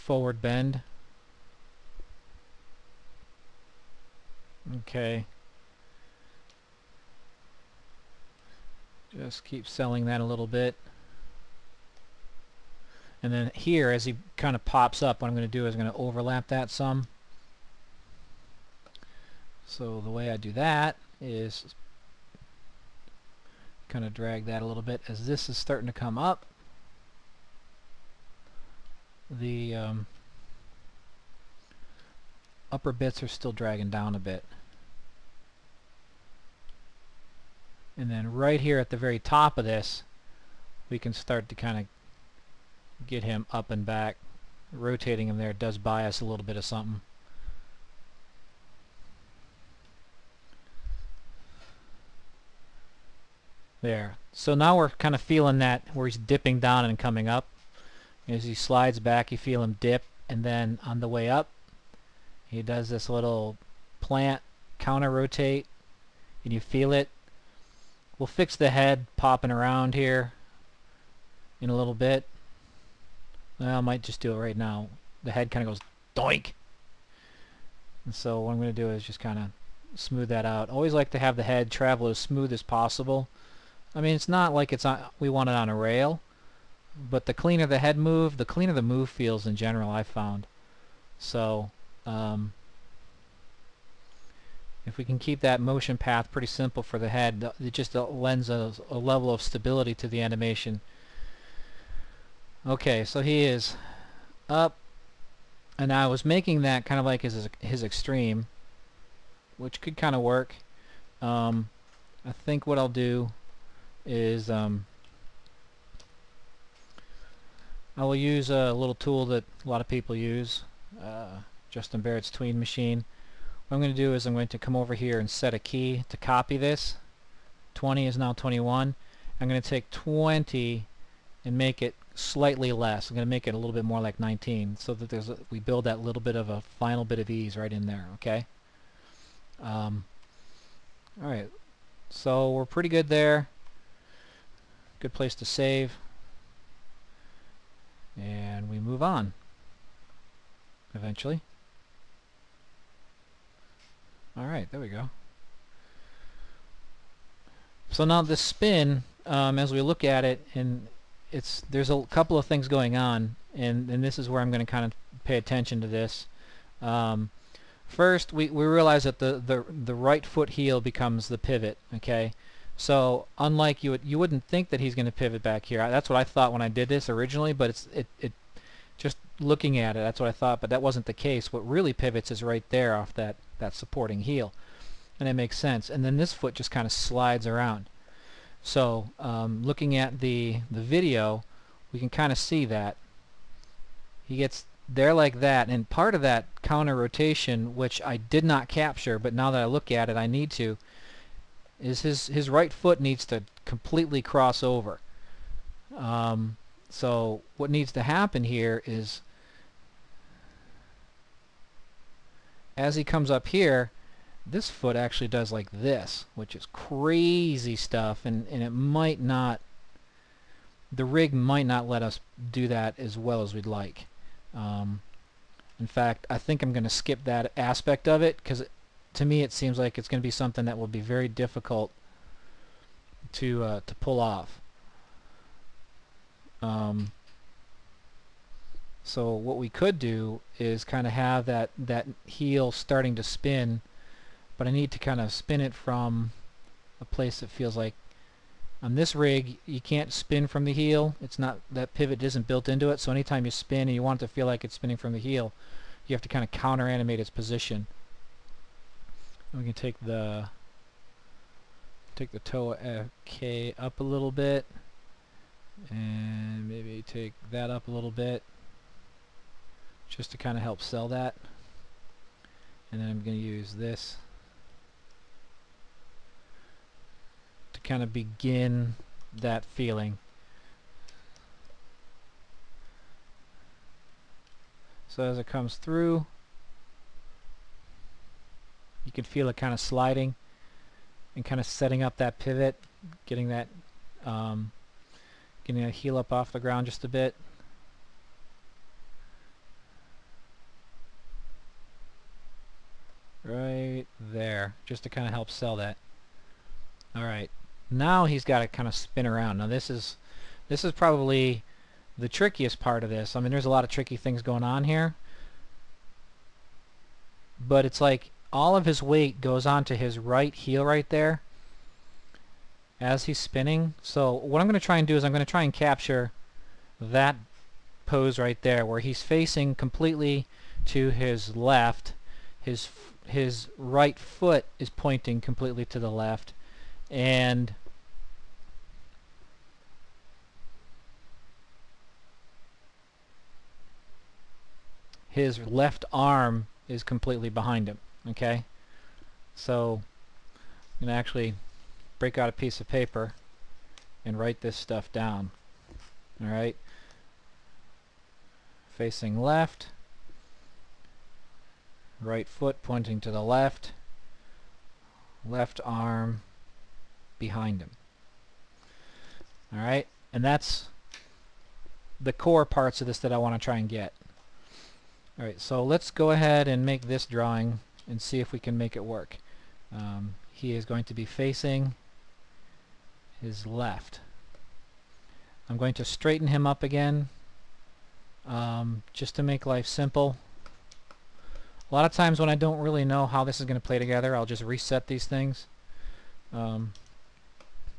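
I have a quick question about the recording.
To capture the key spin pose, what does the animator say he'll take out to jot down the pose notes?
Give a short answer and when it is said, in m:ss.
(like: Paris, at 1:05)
piece of paper, at 5:52.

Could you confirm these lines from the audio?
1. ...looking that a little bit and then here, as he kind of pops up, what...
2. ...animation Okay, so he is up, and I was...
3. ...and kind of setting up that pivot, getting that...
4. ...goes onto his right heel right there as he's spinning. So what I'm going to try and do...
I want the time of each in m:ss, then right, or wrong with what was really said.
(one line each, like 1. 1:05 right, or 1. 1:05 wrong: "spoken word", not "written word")
1. 0:09 wrong: "selling", not "looking"
2. 1:40 right
3. 4:51 right
4. 5:19 right.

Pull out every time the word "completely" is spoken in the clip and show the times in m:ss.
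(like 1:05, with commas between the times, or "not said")
3:23, 5:29, 5:35, 5:47.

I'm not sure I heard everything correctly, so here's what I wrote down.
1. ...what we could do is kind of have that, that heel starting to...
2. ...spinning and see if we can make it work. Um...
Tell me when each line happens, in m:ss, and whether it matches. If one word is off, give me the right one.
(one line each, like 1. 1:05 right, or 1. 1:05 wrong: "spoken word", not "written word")
1. 3:59 right
2. 6:17 wrong: "drawing", not "spinning".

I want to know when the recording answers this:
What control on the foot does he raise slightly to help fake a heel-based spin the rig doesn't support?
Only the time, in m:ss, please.
4:22.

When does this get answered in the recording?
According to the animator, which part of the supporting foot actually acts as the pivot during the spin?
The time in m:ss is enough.
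2:49.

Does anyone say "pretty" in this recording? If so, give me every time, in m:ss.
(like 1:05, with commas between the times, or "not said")
1:36, 2:22.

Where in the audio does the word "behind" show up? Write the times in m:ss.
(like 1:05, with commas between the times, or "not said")
5:47, 6:07.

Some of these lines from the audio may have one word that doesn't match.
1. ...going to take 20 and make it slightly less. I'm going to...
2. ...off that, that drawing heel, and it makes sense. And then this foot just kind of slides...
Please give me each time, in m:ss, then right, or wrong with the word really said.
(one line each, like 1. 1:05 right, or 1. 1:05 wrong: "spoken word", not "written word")
1. 2:09 right
2. 3:02 wrong: "supporting", not "drawing".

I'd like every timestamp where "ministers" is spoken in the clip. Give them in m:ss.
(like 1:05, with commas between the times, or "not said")
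not said.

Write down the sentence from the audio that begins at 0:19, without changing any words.
So the way I do that is kind of drag that a little bit as this is starting to come up.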